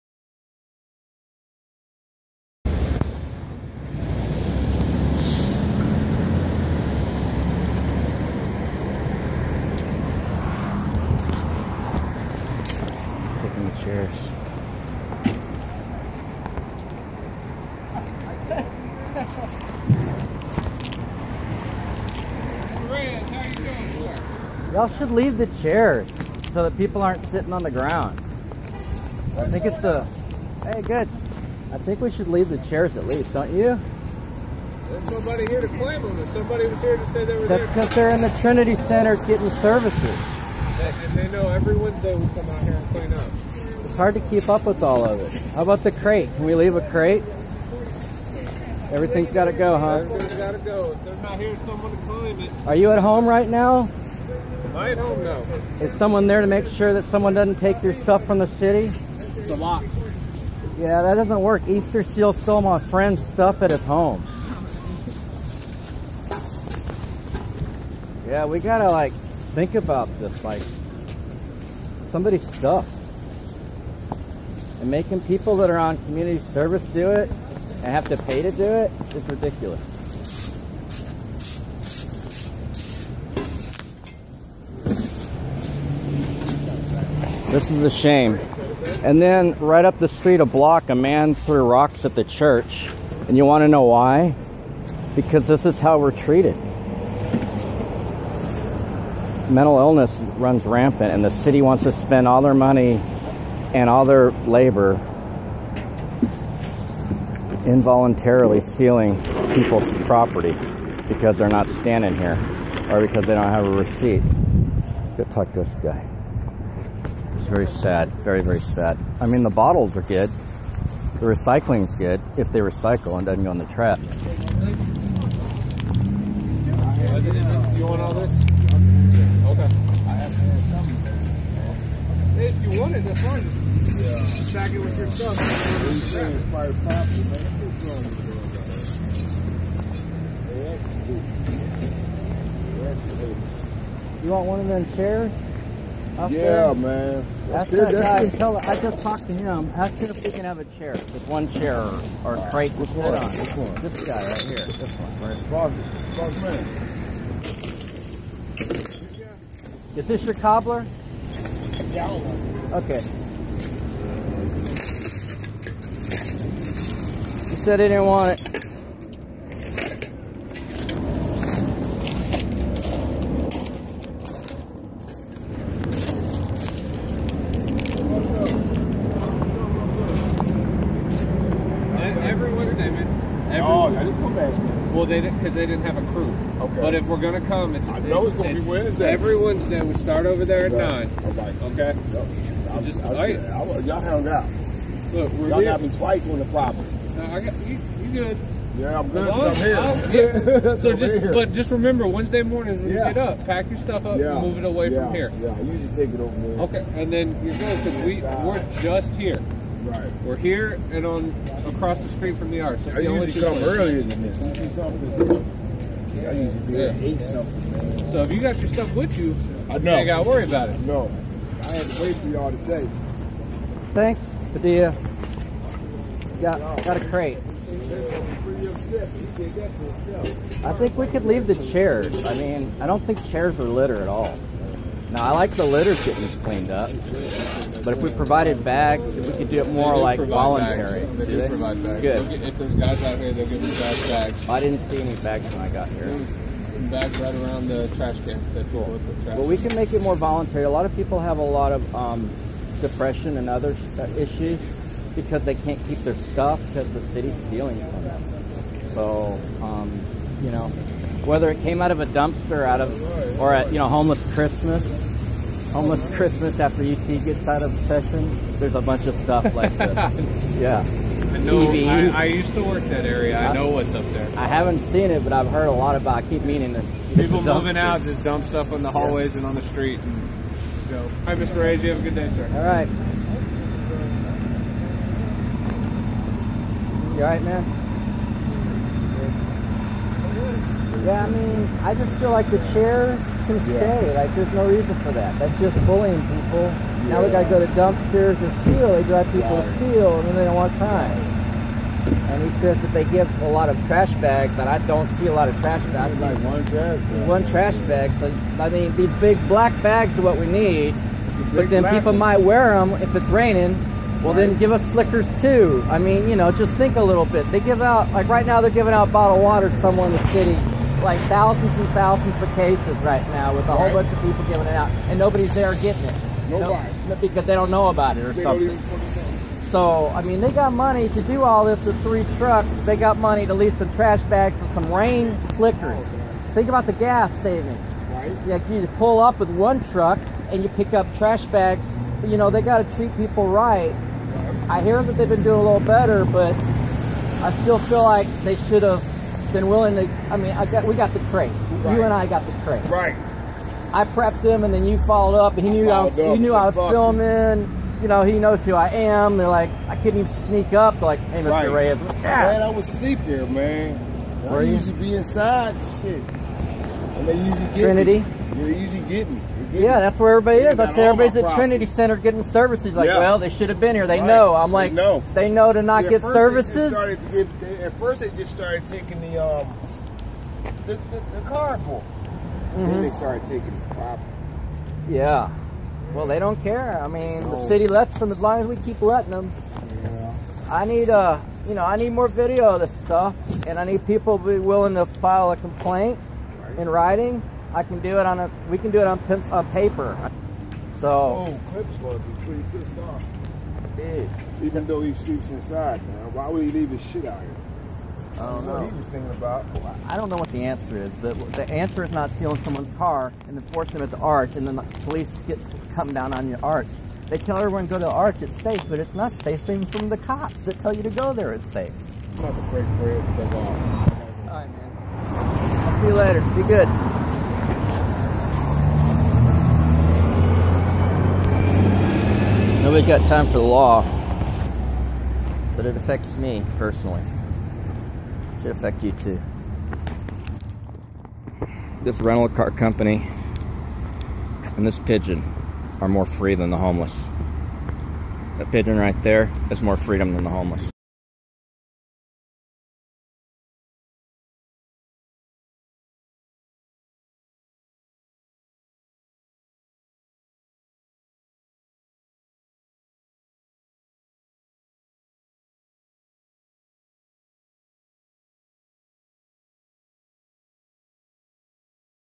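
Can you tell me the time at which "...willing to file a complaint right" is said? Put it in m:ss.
6:34.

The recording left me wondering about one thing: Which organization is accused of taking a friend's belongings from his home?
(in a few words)
Easter Seal.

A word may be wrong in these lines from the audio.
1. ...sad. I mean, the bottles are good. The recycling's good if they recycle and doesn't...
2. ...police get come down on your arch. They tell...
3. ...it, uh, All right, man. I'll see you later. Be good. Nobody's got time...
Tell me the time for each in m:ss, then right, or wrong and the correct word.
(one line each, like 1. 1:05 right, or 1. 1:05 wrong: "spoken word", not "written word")
1. 1:58 right
2. 6:54 right
3. 7:03 right.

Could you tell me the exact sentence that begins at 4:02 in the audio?
Get, if there's guys out here, they'll give you bags.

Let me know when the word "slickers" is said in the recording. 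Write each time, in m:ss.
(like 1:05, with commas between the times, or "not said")
5:14, 5:35.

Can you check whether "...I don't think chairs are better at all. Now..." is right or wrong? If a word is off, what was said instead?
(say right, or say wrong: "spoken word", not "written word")
wrong: "litter", not "better".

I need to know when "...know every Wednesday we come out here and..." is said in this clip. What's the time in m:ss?
0:41.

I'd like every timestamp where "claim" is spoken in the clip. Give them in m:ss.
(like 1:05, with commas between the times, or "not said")
0:35, 0:52.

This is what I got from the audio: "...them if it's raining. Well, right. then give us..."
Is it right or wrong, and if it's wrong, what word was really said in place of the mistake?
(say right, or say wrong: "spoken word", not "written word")
right.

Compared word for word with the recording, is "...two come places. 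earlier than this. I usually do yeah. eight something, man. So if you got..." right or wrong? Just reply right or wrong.
right.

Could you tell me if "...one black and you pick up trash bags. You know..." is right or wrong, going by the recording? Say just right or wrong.
wrong.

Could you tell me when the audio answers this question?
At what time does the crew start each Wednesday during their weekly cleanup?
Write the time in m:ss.
3:10.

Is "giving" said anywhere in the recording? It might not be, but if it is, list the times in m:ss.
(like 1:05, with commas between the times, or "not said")
5:18, 5:24.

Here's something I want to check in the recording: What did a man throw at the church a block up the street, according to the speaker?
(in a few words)
Rocks.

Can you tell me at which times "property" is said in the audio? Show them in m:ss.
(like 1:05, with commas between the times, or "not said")
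1:50, 3:16, 6:23.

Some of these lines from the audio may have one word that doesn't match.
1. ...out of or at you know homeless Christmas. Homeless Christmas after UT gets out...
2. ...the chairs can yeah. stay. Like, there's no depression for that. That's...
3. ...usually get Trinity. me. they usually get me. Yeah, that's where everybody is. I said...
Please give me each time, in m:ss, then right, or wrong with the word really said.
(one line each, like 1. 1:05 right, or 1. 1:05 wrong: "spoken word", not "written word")
1. 4:22 right
2. 4:52 wrong: "reason", not "depression"
3. 6:07 right.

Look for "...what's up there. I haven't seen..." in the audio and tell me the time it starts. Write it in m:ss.
4:33.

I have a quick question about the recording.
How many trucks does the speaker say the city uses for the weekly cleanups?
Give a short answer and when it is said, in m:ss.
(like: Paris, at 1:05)
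3, at 5:32.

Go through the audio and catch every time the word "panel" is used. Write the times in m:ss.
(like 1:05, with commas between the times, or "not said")
not said.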